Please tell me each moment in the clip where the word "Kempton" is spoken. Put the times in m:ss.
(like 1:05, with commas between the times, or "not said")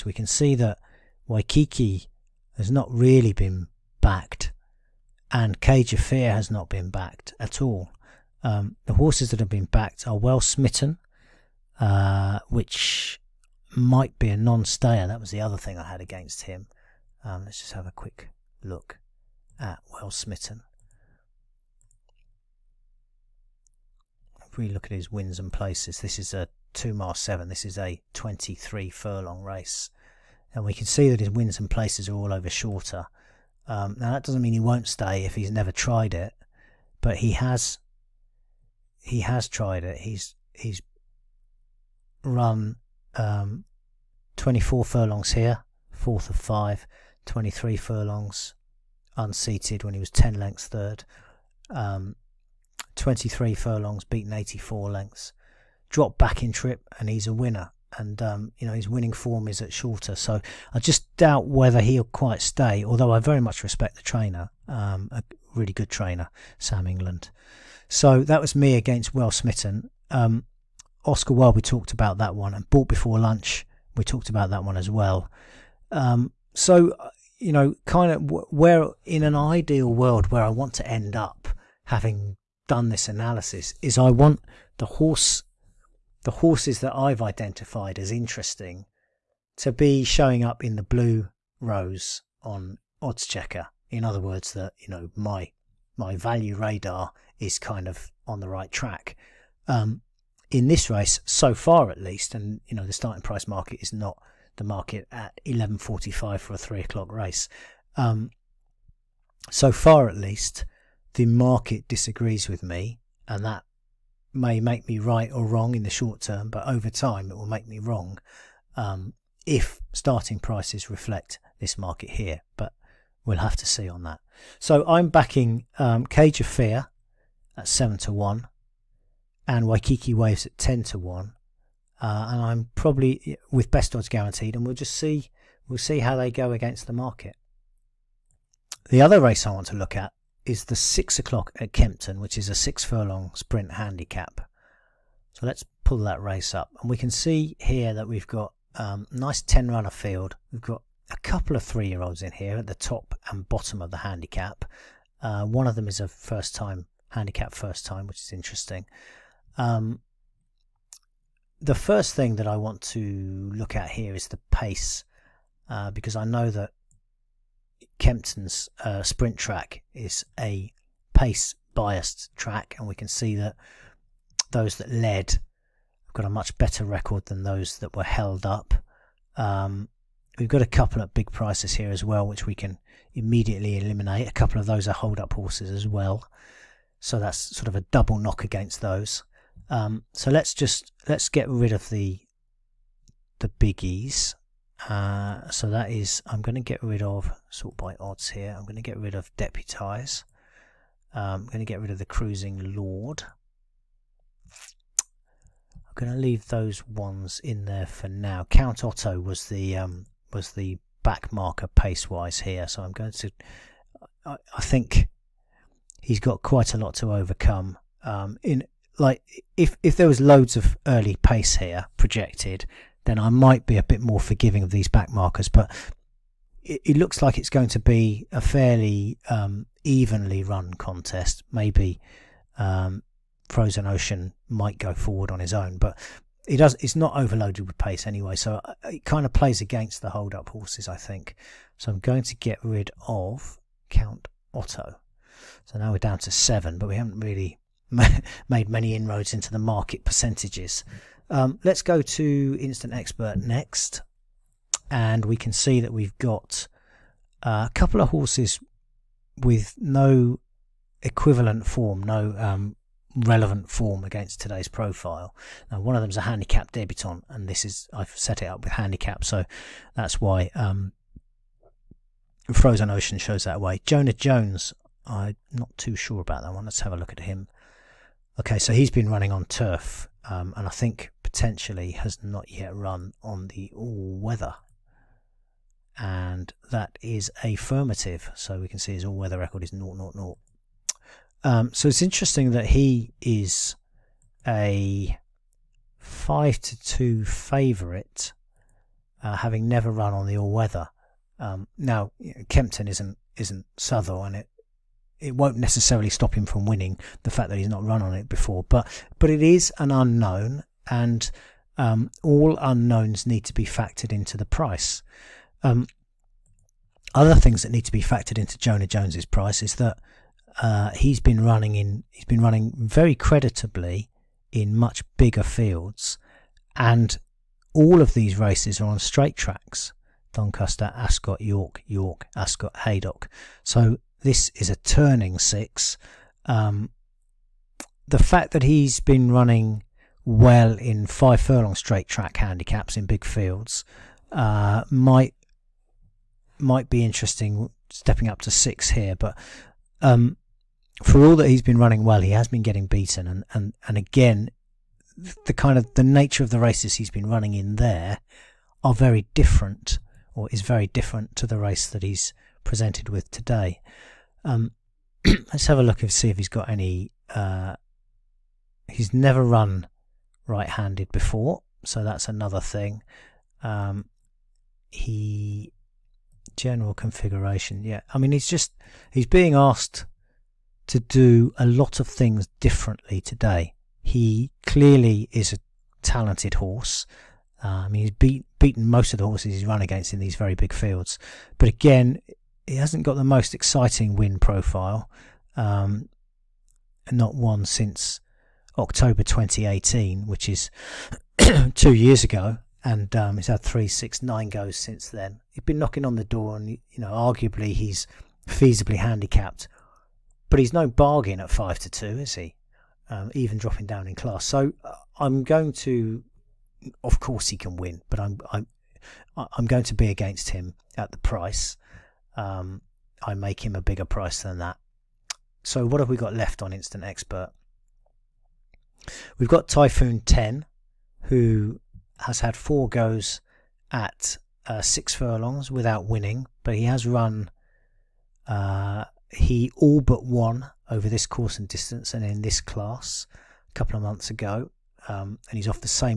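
2:21, 2:47, 5:02.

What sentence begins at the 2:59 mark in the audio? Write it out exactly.
Um, we've got a couple of big prices here as well which we can immediately eliminate.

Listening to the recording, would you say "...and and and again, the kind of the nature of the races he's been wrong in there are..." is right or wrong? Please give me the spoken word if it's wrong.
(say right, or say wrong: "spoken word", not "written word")
wrong: "running", not "wrong".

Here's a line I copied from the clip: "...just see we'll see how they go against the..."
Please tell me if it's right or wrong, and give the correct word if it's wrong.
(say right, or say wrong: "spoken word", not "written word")
right.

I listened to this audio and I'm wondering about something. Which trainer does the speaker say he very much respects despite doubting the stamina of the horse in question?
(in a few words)
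Sam England.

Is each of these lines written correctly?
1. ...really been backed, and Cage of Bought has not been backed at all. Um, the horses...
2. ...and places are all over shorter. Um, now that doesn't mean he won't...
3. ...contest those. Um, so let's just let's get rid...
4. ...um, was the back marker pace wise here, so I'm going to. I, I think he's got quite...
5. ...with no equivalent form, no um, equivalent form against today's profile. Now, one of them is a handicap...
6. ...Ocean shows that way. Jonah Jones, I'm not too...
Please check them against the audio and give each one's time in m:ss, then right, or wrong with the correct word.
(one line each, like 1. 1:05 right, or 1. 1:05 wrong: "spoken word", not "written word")
1. 0:02 wrong: "Fear", not "Bought"
2. 0:31 right
3. 3:08 wrong: "against", not "contest"
4. 3:29 right
5. 4:19 wrong: "relevant", not "equivalent"
6. 4:32 right.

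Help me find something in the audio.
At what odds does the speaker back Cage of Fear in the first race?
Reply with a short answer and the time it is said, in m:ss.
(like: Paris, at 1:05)
7 to 1, at 2:07.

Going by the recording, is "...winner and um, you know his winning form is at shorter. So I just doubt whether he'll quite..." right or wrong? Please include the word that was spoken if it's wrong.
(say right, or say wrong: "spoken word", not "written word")
right.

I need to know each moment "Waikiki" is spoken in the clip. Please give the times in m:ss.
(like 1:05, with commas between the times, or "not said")
0:01, 2:09.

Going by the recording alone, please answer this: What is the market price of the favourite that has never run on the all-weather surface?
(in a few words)
5 to 2.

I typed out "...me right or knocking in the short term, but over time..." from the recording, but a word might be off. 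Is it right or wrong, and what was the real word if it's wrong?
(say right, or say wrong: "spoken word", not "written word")
wrong: "wrong", not "knocking".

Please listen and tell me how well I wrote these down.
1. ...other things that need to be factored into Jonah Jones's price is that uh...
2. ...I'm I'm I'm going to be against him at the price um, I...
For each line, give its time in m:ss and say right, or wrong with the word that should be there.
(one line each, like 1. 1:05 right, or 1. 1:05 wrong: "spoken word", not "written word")
1. 5:17 right
2. 6:58 right.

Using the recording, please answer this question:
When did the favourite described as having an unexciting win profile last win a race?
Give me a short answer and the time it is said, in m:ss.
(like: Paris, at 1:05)
October 2018, at 6:38.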